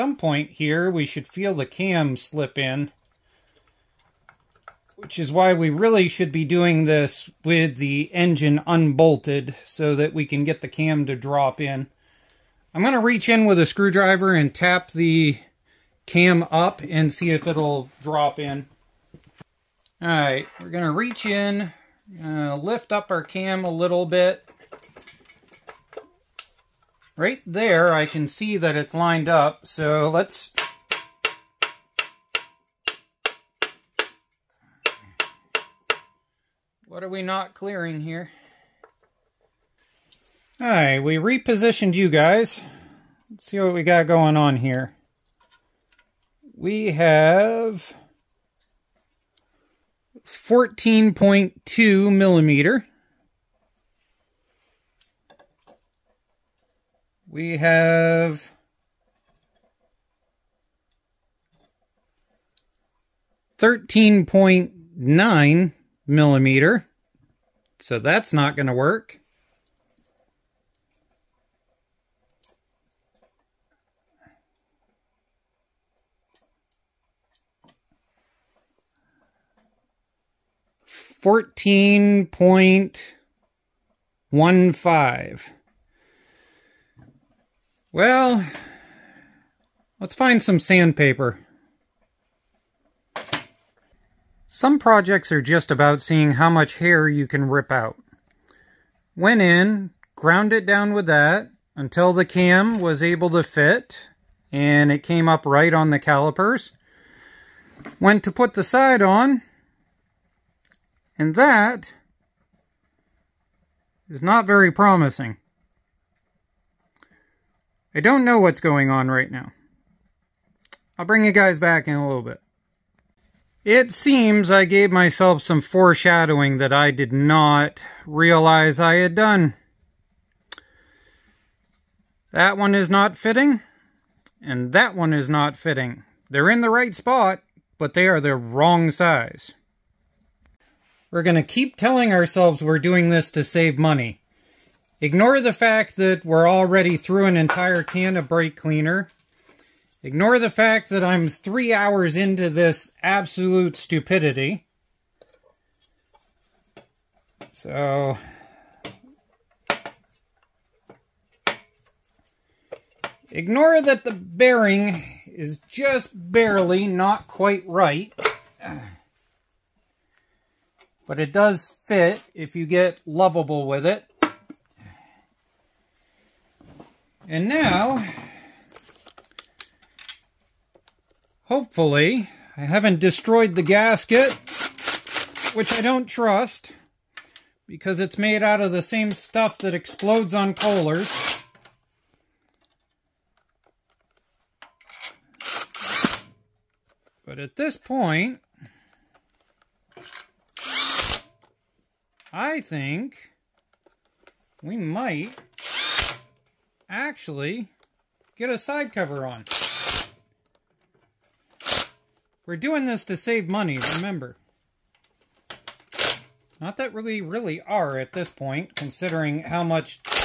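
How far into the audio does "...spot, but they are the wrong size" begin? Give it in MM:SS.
02:16.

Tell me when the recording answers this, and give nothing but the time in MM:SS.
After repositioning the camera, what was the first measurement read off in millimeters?
00:50.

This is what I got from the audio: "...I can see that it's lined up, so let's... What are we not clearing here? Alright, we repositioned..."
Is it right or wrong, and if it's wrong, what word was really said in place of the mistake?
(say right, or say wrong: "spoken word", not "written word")
right.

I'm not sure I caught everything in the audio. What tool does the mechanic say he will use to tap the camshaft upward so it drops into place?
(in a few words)
Screwdriver.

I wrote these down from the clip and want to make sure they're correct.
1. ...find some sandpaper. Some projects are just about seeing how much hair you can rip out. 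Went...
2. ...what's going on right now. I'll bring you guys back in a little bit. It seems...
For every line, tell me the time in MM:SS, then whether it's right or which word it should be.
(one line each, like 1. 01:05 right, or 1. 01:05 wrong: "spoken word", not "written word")
1. 01:30 right
2. 01:58 right.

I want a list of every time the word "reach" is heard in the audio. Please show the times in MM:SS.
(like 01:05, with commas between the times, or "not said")
00:12, 00:20.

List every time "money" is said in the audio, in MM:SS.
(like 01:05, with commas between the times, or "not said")
02:23, 03:33.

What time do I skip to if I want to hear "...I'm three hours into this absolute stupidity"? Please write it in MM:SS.
02:31.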